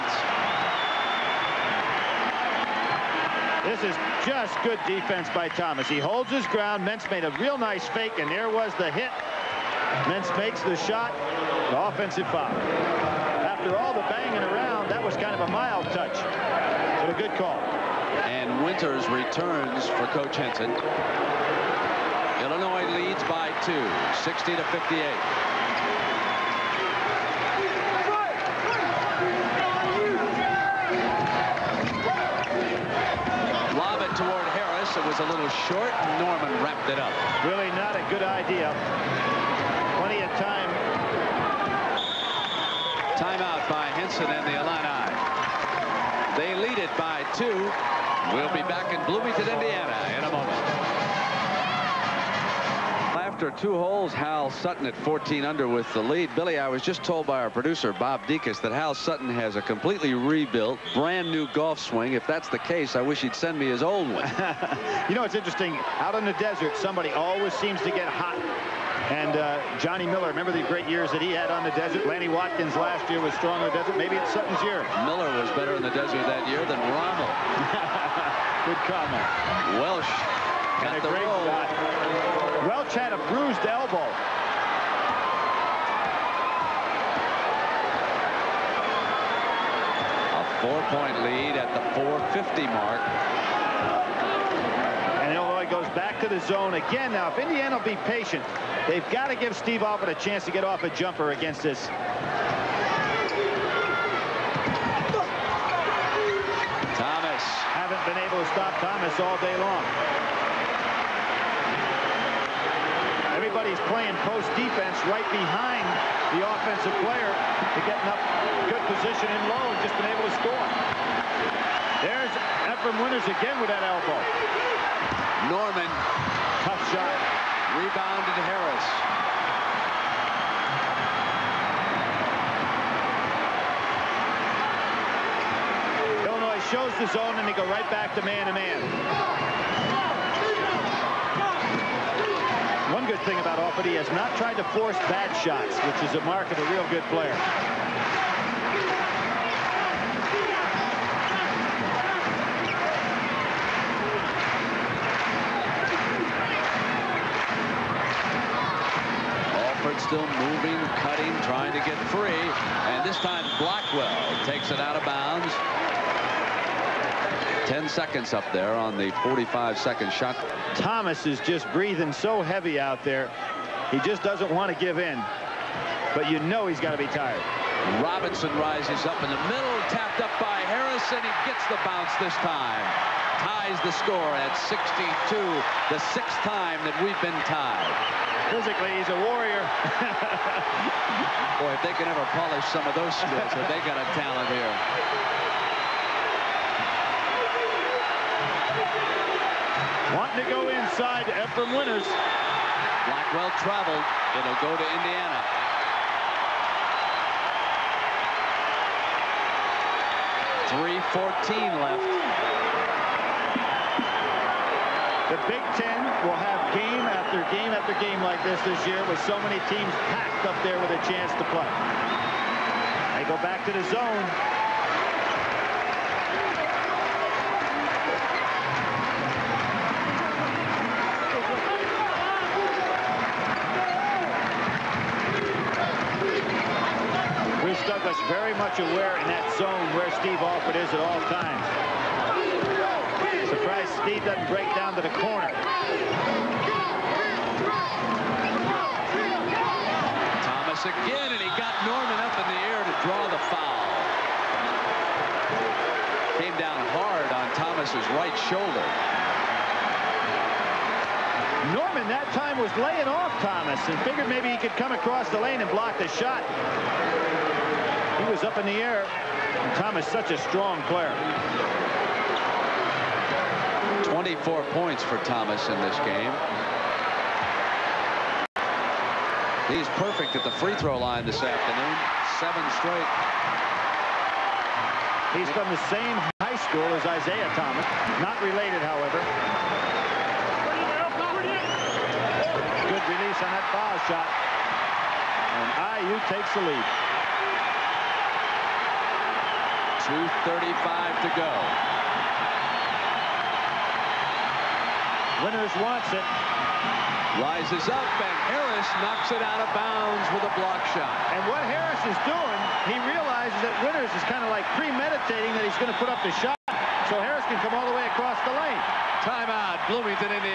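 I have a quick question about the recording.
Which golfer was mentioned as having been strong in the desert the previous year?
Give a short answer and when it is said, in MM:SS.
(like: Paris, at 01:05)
Lanny Wadkins, at 01:12.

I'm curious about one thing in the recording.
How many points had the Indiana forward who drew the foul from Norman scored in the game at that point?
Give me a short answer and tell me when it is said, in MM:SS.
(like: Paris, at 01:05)
24, at 04:34.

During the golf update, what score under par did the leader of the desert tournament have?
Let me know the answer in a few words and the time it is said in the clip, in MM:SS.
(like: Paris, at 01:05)
14 under, at 00:54.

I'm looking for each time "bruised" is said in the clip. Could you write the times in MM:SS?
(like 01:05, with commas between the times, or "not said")
01:23.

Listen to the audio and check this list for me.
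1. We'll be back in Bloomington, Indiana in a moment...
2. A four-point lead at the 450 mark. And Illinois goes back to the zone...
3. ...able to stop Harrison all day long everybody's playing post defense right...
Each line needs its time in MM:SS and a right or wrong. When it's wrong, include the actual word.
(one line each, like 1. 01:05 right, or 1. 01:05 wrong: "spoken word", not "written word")
1. 00:48 right
2. 01:30 right
3. 01:48 wrong: "Thomas", not "Harrison".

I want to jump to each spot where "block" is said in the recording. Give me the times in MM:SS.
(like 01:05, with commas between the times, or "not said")
04:25, 05:10.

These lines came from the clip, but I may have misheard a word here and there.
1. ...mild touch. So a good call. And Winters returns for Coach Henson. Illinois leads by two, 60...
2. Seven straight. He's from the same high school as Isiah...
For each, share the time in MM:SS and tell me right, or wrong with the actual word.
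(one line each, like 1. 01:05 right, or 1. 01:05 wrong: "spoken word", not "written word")
1. 00:15 right
2. 04:42 right.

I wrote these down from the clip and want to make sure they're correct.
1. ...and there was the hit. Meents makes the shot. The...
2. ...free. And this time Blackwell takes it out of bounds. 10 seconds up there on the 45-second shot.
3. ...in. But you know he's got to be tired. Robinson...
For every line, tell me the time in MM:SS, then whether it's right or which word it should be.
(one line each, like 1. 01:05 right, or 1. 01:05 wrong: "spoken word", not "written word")
1. 00:08 right
2. 02:42 right
3. 02:54 right.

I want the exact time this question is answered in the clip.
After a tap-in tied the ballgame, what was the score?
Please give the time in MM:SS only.
03:04.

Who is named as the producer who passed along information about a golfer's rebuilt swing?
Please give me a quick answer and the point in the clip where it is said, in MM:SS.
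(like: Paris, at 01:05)
Bob Dekas, at 00:57.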